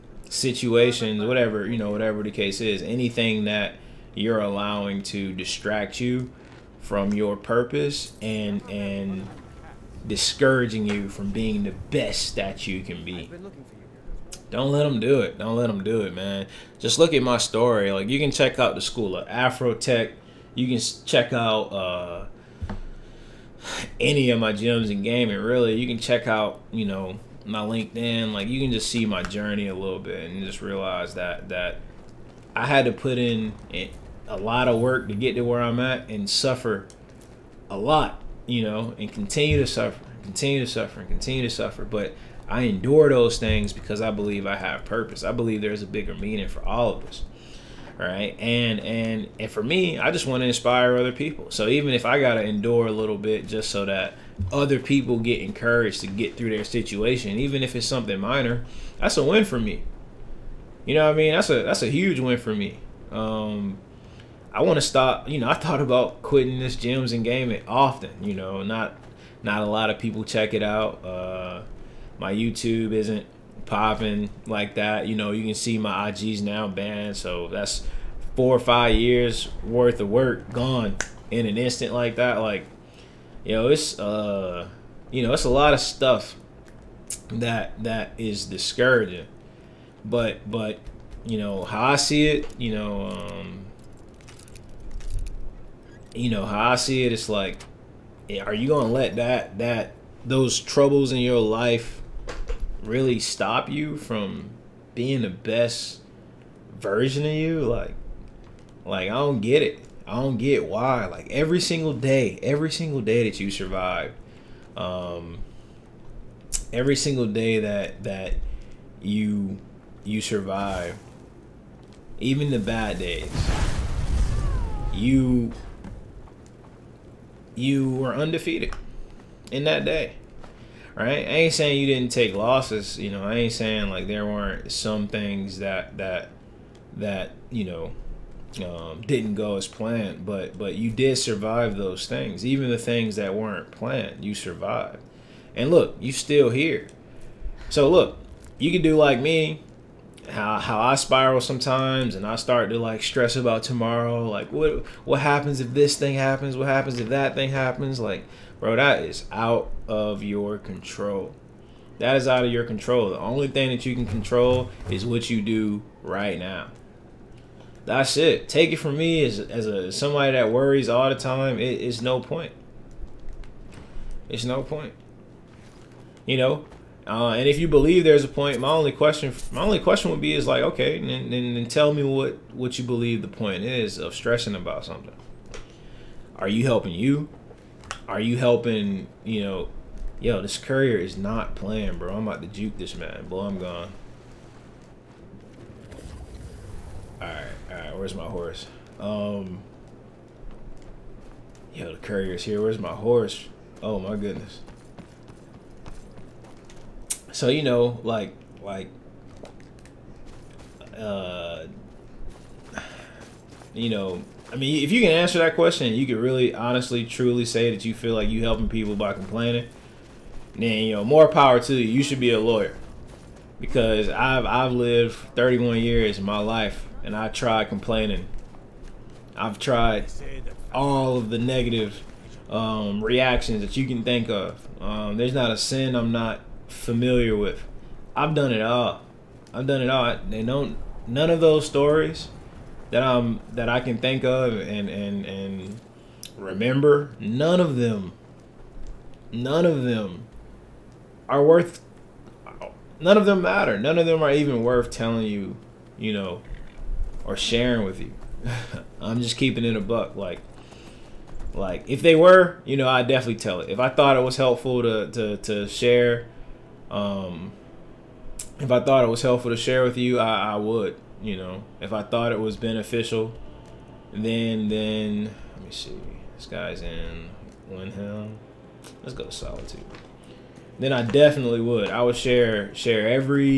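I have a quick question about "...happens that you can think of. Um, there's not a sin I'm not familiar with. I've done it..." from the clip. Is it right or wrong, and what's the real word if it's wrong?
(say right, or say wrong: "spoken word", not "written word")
wrong: "reactions", not "happens".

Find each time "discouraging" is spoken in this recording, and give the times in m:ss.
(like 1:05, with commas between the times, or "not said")
0:10, 1:28.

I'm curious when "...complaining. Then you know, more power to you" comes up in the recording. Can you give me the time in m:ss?
3:39.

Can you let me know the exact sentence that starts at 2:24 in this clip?
You survived, and look, you still here.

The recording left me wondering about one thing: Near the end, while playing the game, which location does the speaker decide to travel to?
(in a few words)
Solitude.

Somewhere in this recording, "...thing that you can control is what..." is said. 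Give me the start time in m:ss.
2:43.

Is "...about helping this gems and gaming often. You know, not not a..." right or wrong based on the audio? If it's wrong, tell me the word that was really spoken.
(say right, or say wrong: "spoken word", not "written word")
wrong: "quitting", not "helping".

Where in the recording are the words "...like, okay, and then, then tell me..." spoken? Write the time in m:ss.
3:00.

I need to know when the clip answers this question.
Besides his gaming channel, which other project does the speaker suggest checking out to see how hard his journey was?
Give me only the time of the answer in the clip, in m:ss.
0:18.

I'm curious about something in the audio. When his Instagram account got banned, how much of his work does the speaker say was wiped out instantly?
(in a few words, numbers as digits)
4 or 5 years.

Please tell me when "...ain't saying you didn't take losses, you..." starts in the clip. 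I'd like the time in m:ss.
2:11.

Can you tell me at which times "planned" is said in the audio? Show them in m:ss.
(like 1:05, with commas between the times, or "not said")
2:19, 2:23.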